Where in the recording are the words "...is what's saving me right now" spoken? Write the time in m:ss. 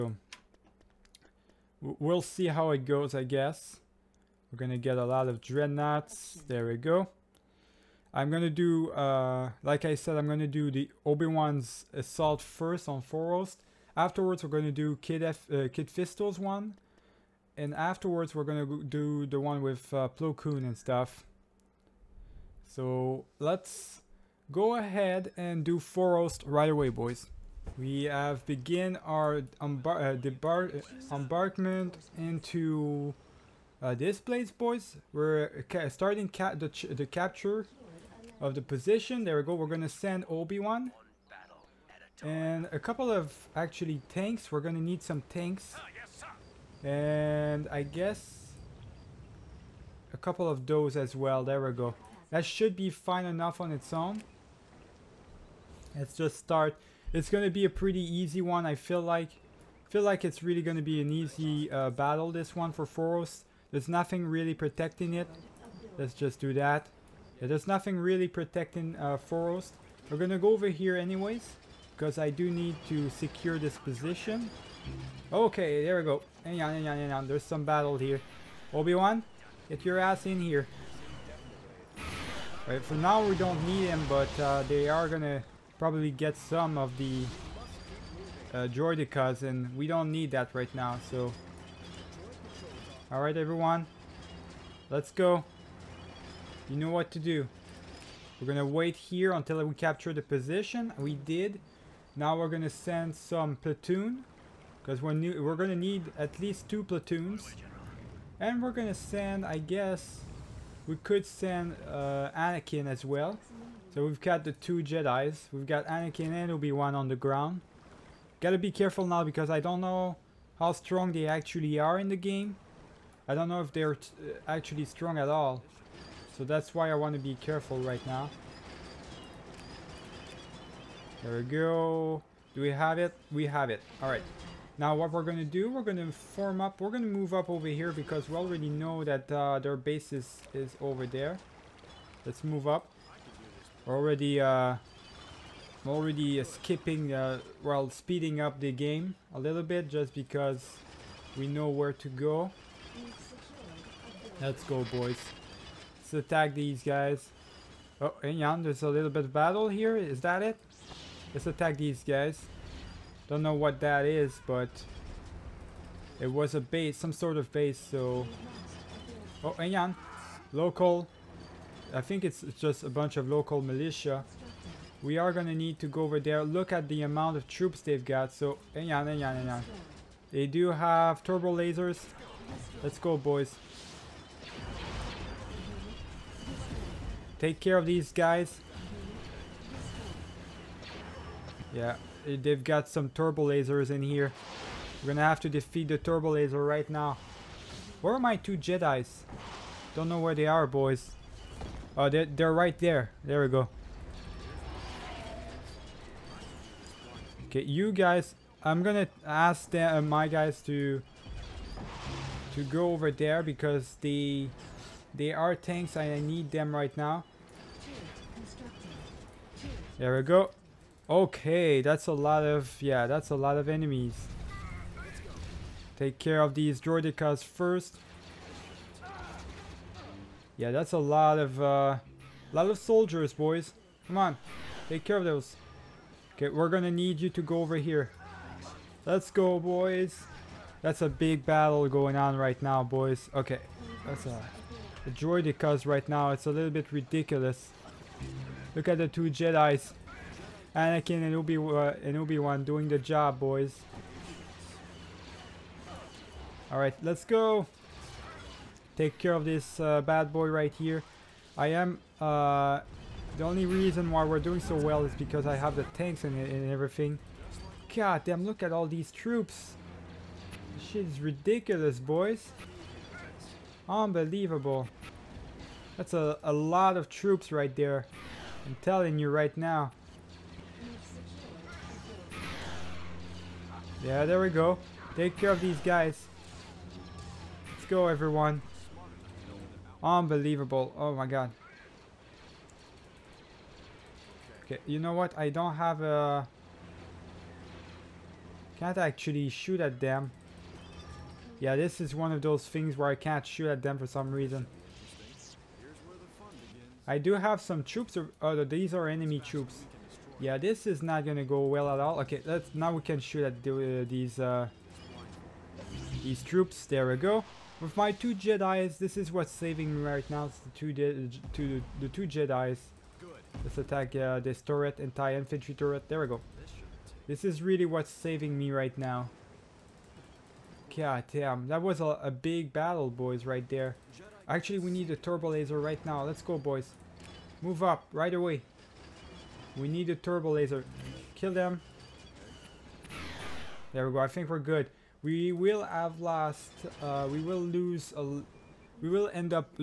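5:19.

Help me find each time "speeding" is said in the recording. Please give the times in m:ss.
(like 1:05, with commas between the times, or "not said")
2:27.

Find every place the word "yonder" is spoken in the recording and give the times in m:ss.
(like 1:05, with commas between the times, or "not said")
2:38.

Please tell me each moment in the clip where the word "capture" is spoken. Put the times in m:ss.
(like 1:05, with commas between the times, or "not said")
0:37, 1:39.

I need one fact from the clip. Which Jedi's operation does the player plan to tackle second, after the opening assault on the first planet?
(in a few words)
Kit Fisto.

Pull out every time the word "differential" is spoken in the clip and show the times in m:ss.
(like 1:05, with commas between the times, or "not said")
not said.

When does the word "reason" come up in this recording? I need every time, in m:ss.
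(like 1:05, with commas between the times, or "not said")
4:23, 5:04.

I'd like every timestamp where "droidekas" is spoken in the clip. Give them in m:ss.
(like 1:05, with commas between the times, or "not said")
3:46, 4:05.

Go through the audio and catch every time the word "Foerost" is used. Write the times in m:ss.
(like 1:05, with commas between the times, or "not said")
0:13, 0:25, 1:02, 1:09.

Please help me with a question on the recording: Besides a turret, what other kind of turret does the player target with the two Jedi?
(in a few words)
infantry turret.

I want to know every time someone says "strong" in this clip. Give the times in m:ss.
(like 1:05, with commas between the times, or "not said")
2:00, 2:04.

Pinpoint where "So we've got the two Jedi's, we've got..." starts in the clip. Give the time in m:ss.
1:53.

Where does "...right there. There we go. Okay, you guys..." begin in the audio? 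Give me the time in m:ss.
3:22.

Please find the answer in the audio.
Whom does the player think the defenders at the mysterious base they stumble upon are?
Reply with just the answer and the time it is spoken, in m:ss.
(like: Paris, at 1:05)
local militia, at 2:53.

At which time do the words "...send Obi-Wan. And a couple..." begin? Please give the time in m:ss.
0:39.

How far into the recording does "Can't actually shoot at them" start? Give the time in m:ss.
4:58.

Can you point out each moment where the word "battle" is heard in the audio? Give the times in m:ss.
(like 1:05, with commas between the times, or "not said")
1:01, 1:17, 2:39, 4:01, 5:32.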